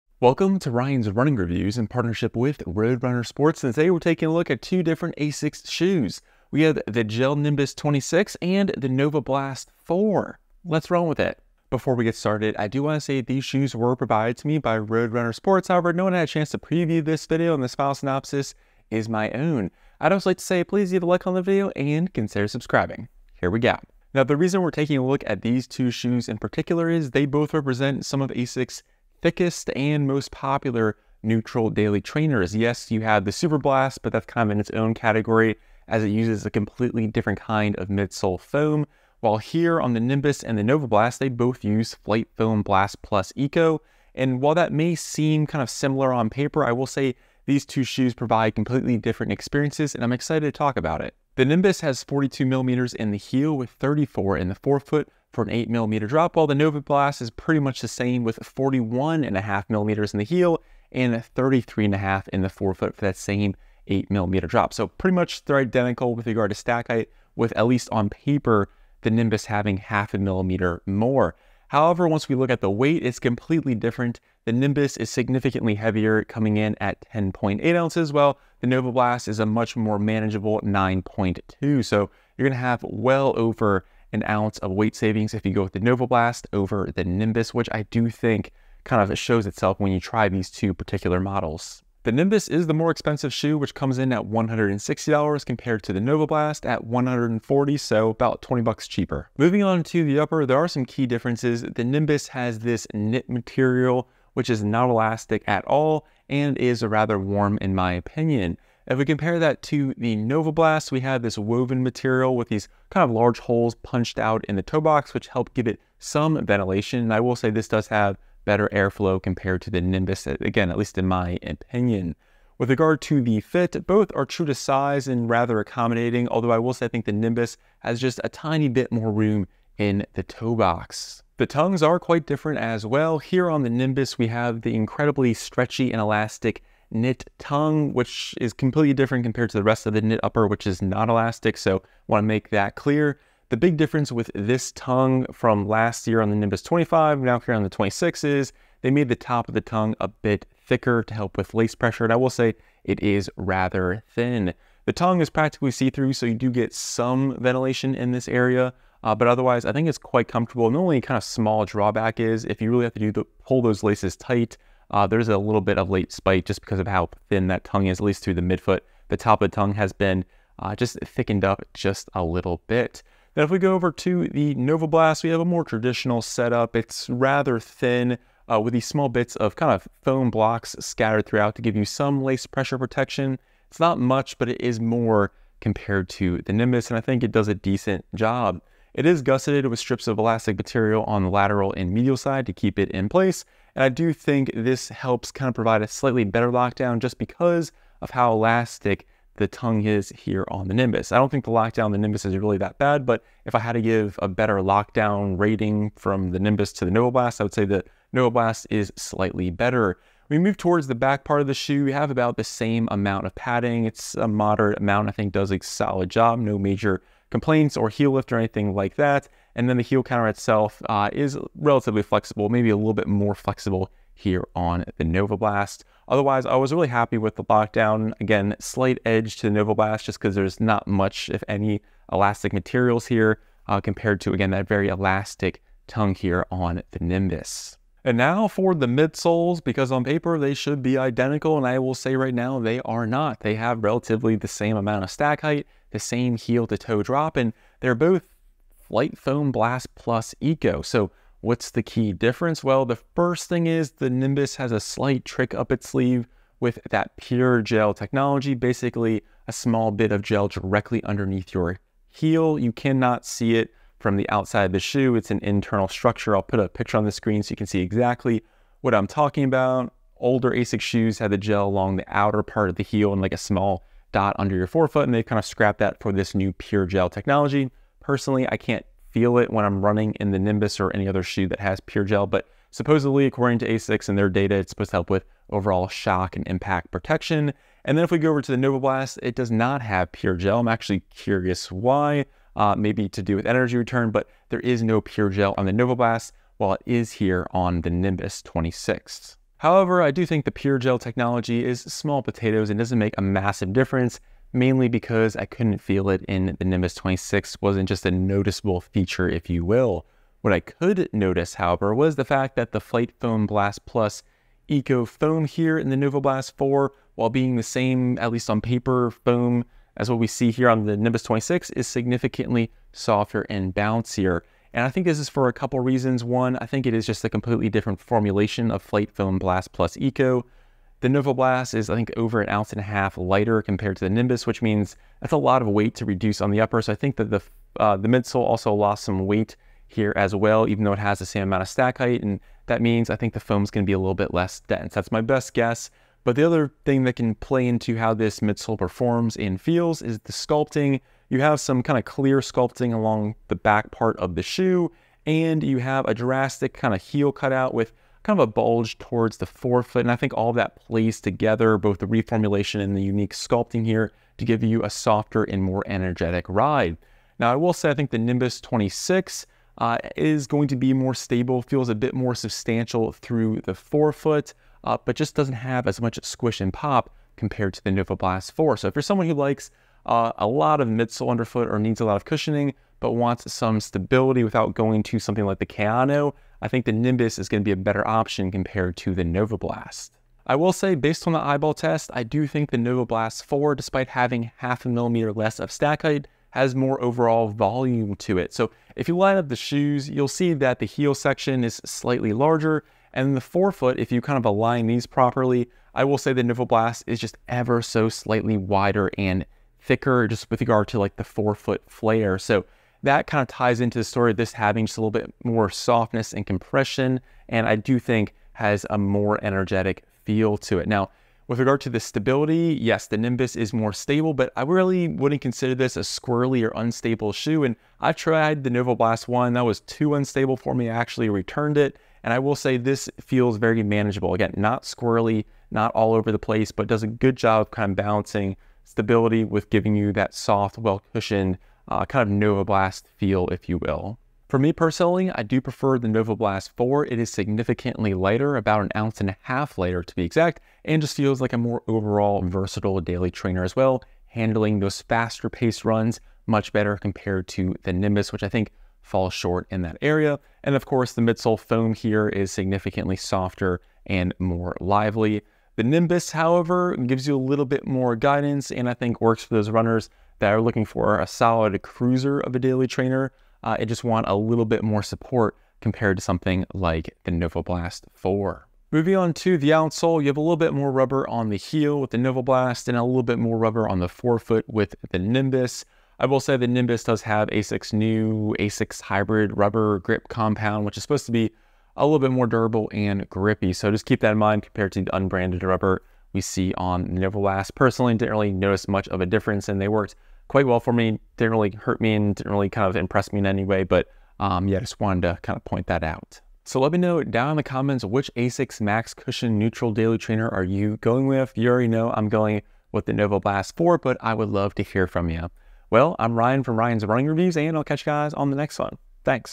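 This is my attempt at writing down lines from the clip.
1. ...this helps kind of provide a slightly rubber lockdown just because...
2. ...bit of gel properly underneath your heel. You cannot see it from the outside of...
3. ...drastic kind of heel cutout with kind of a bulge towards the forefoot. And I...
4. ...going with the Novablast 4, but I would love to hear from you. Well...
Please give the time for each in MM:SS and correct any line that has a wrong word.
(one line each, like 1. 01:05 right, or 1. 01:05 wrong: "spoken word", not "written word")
1. 03:14 wrong: "better", not "rubber"
2. 04:19 wrong: "directly", not "properly"
3. 05:56 right
4. 08:32 right.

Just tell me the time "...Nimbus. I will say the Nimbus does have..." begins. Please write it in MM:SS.
08:05.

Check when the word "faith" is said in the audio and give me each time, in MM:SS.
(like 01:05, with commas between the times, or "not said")
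not said.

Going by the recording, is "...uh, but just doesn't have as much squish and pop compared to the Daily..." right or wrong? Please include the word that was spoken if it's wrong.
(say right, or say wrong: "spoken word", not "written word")
wrong: "Novablast", not "Daily".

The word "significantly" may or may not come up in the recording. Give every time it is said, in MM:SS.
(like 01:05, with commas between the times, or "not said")
01:15, 05:21, 07:27, 07:42.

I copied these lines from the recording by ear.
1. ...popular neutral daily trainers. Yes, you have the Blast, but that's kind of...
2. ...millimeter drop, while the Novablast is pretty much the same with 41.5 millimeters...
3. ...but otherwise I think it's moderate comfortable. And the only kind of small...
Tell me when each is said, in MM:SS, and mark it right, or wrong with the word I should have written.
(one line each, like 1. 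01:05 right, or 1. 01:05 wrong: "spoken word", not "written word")
1. 00:30 wrong: "Superblast", not "Blast"
2. 00:55 right
3. 02:39 wrong: "quite", not "moderate".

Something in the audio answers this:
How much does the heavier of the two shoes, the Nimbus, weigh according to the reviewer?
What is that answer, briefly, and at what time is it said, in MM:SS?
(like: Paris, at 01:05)
10.8 ounces, at 01:17.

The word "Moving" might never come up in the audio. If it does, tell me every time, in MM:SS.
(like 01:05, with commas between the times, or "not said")
01:39, 07:58.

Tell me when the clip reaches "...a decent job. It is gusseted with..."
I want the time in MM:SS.
03:07.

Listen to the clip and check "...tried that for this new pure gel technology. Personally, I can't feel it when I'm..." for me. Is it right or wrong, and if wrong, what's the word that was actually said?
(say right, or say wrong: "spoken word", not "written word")
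wrong: "scrapped", not "tried".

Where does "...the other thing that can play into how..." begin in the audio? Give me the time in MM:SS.
05:46.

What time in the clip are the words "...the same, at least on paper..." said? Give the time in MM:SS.
05:17.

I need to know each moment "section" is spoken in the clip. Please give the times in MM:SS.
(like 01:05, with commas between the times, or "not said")
06:41.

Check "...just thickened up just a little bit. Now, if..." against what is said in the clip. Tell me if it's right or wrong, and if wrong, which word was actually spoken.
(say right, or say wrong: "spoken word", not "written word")
right.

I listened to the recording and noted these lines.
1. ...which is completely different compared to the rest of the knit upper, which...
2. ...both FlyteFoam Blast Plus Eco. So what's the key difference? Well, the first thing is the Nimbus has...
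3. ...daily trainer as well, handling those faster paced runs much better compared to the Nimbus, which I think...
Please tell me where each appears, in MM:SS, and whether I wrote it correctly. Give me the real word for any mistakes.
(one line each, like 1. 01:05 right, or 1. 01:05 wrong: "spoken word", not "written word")
1. 02:17 right
2. 04:07 right
3. 07:33 right.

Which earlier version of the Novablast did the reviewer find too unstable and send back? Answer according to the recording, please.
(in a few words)
Novablast 1.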